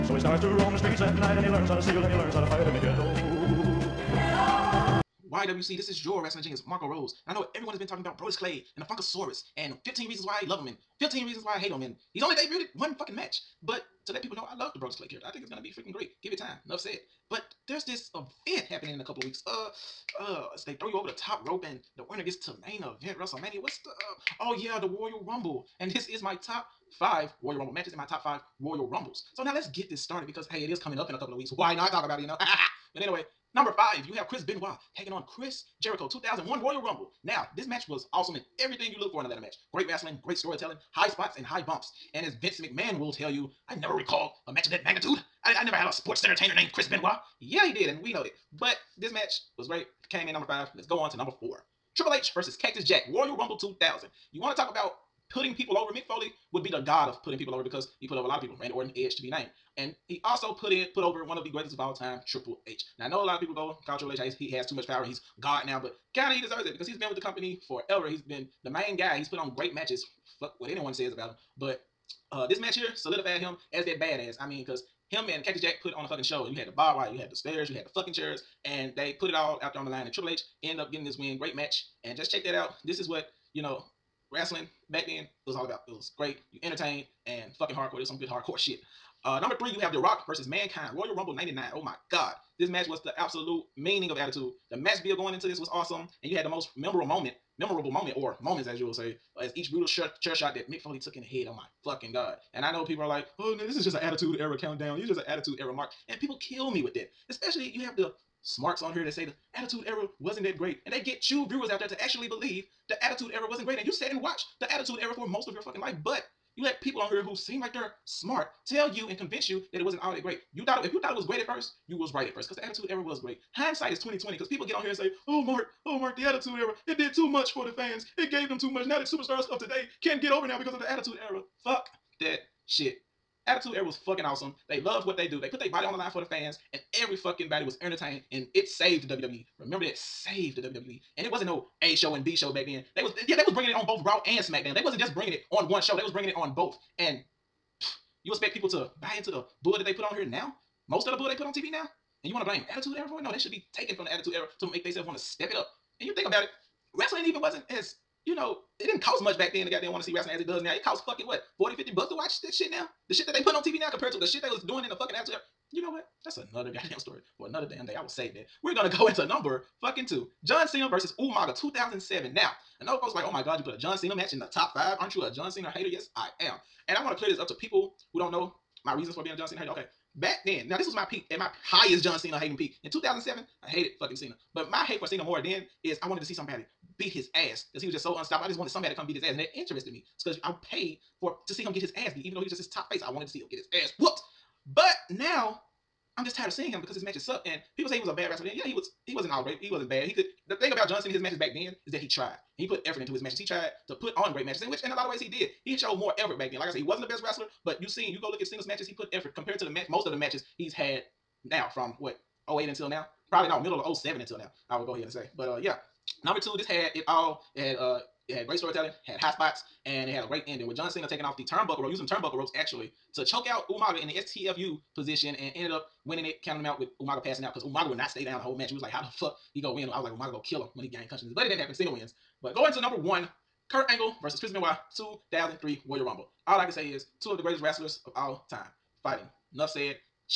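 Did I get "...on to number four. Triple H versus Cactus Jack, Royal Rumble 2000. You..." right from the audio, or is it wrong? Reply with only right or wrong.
right.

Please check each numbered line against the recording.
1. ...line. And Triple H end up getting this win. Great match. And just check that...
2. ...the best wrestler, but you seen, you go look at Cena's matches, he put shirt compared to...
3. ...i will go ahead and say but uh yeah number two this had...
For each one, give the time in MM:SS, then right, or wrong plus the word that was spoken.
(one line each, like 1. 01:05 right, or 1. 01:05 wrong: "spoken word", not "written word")
1. 01:19 right
2. 03:27 wrong: "effort", not "shirt"
3. 03:34 right.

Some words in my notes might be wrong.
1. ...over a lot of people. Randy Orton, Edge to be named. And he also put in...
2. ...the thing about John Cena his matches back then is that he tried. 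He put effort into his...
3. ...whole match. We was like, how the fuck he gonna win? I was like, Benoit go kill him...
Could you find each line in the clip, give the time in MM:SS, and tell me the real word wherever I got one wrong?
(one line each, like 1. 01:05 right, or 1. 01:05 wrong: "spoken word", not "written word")
1. 00:58 right
2. 03:20 right
3. 03:48 wrong: "Umaga", not "Benoit".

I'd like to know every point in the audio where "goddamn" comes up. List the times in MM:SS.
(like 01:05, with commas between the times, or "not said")
02:39, 02:46.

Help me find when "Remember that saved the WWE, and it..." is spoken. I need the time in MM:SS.
02:19.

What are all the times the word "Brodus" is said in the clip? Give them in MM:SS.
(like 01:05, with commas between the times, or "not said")
00:08, 00:14.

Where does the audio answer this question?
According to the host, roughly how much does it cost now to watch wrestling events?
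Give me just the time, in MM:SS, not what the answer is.
02:41.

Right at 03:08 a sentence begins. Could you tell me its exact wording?
I just wanted somebody to come beat his ass, and it interested me.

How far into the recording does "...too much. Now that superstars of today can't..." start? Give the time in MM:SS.
02:08.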